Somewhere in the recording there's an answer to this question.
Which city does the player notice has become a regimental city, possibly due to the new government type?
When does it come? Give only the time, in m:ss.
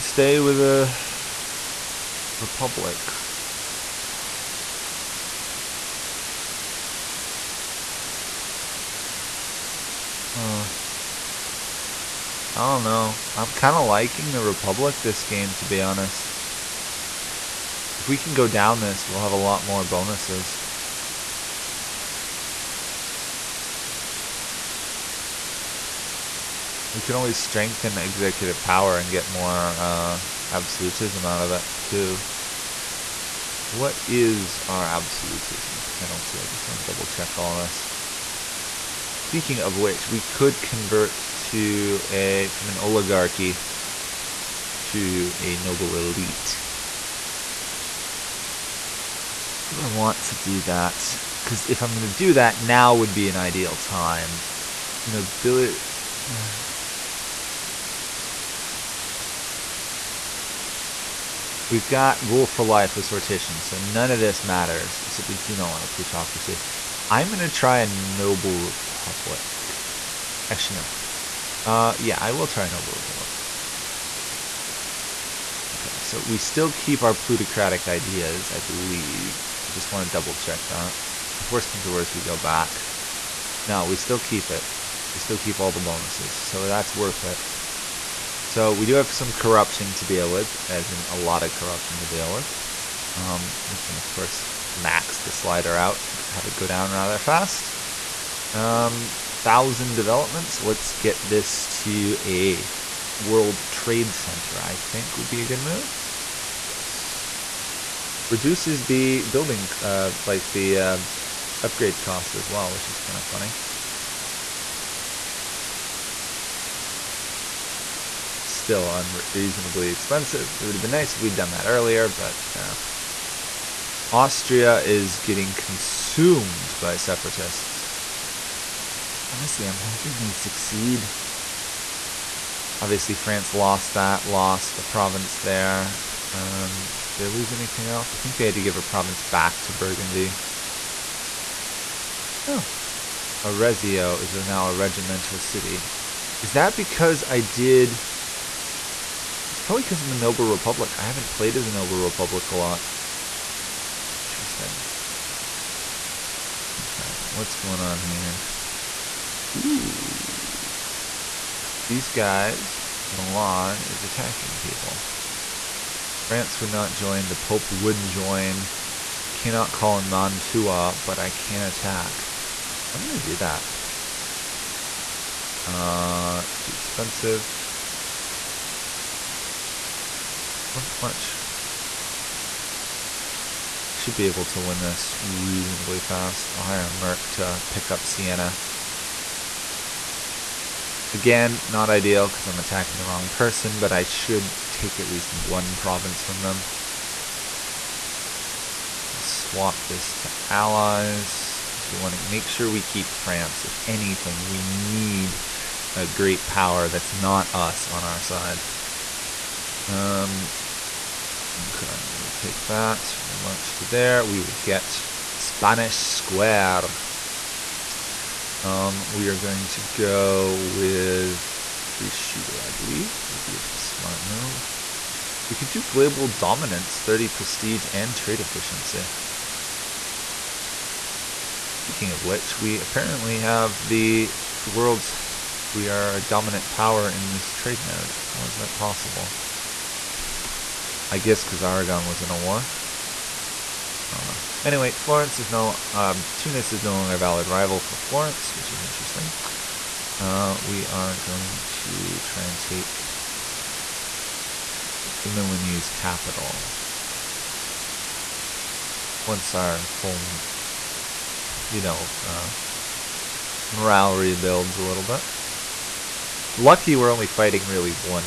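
2:23.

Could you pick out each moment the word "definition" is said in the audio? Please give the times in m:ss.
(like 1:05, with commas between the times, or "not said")
not said.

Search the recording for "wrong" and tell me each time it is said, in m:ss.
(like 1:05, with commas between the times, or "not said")
3:13.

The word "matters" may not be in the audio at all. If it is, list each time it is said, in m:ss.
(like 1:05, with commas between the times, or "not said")
1:04.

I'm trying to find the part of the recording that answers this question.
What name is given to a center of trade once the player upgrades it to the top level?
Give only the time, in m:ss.
1:43.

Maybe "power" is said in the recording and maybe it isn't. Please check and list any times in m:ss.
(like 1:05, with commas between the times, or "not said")
0:28, 3:26, 3:56.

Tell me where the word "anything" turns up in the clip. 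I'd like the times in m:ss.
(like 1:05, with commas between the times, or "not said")
2:17, 3:23.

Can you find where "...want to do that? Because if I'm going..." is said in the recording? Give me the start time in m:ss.
0:49.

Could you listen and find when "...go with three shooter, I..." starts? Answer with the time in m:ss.
3:39.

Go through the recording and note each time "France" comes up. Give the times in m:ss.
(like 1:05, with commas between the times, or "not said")
2:13, 2:46, 3:23.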